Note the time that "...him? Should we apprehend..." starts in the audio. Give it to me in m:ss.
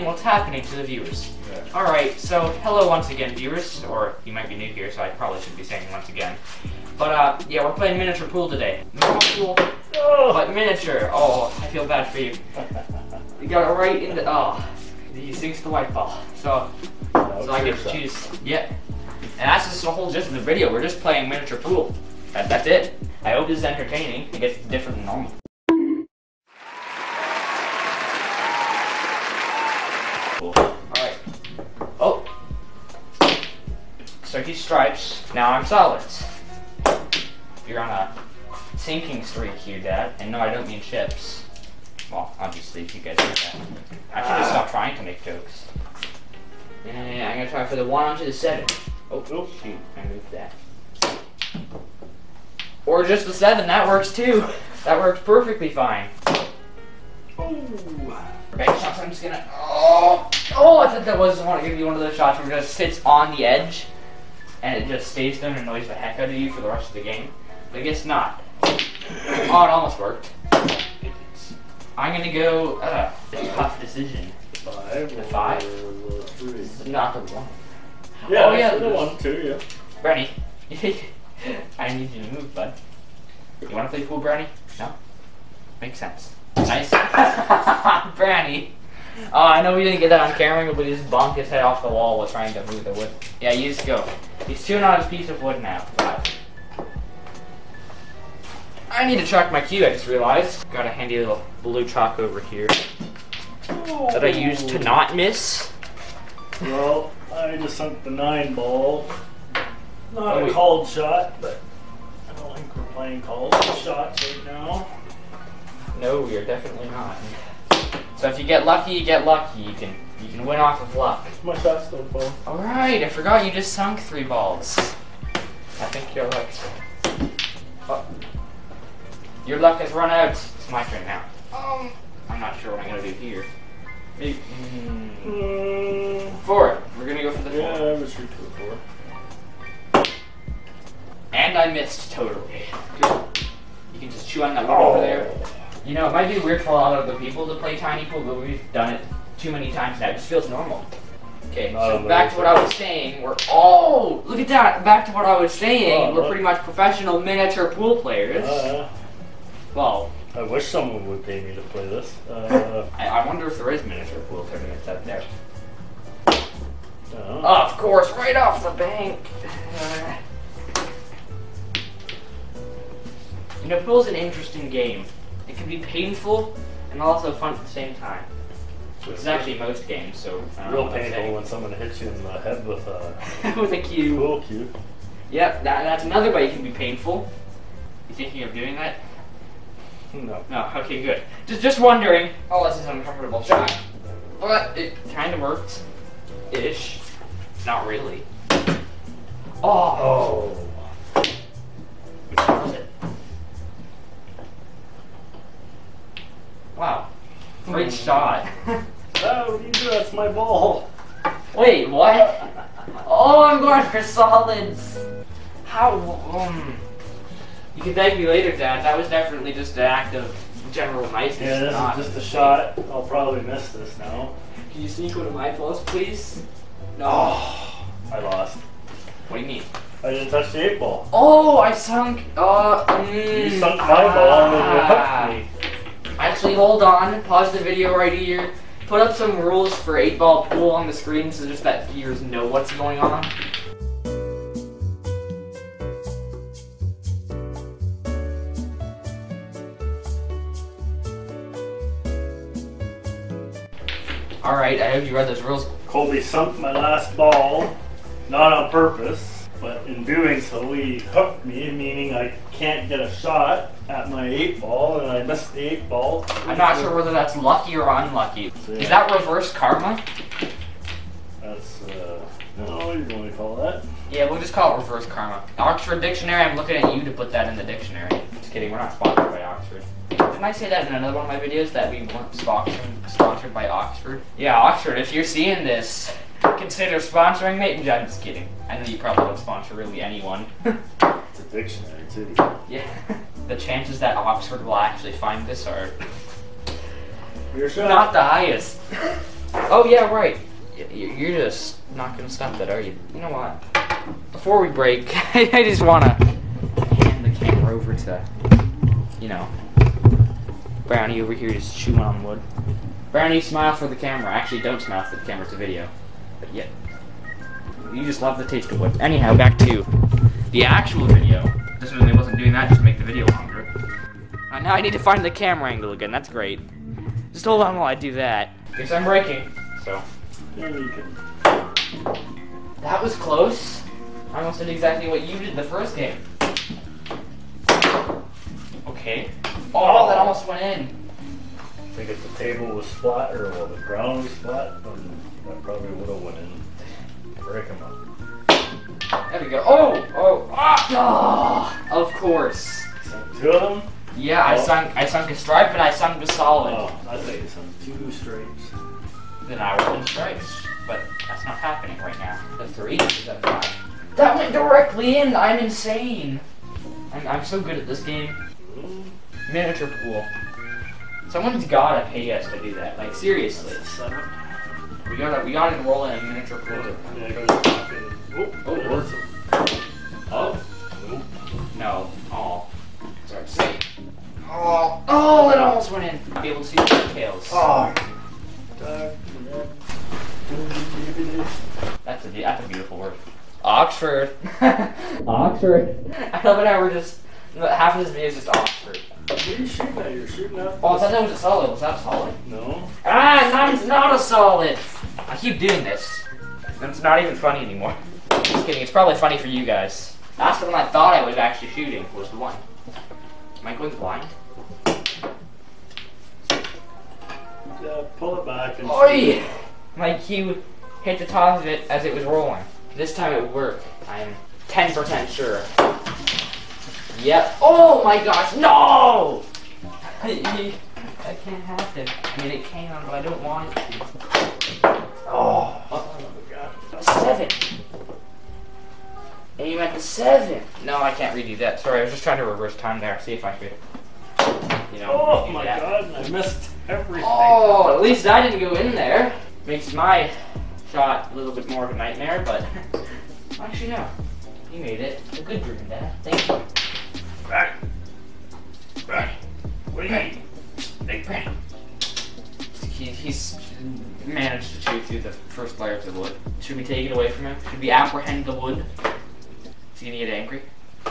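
7:47.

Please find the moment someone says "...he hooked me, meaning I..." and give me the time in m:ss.
4:20.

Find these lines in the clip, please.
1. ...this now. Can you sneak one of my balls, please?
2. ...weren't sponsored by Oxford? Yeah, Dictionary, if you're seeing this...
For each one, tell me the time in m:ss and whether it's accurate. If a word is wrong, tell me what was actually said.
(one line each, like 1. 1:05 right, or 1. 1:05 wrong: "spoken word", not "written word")
1. 3:43 right
2. 4:42 wrong: "Oxford", not "Dictionary".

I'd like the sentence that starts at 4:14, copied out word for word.
Alright, I hope you read those rules.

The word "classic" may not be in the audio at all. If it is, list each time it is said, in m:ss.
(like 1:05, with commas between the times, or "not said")
not said.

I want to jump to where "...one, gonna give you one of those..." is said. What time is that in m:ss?
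1:01.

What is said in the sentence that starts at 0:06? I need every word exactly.
But uh, yeah, we're playing miniature pool today.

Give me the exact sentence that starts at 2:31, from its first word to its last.
Okay, so back to what I was saying.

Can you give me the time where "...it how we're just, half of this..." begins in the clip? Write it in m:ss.
6:36.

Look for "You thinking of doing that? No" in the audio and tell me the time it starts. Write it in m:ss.
3:08.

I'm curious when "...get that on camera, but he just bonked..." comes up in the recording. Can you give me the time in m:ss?
1:30.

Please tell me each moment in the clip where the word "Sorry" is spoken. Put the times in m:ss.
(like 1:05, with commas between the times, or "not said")
6:23, 7:21.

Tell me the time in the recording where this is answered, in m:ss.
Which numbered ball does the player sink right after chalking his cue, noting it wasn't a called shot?
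1:48.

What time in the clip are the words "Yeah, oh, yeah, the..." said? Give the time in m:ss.
1:18.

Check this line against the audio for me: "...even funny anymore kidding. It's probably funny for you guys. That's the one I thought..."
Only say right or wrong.
right.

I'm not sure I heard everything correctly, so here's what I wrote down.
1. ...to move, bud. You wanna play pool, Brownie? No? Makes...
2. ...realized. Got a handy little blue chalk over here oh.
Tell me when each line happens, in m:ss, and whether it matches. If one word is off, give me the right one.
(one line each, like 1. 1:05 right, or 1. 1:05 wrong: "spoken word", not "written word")
1. 1:22 right
2. 1:40 right.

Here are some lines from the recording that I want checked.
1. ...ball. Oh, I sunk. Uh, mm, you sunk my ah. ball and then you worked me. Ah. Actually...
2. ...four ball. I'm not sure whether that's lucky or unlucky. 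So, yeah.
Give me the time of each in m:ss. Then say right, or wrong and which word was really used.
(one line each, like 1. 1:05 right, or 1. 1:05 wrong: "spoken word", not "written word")
1. 3:50 wrong: "hooked", not "worked"
2. 4:25 wrong: "eight", not "four".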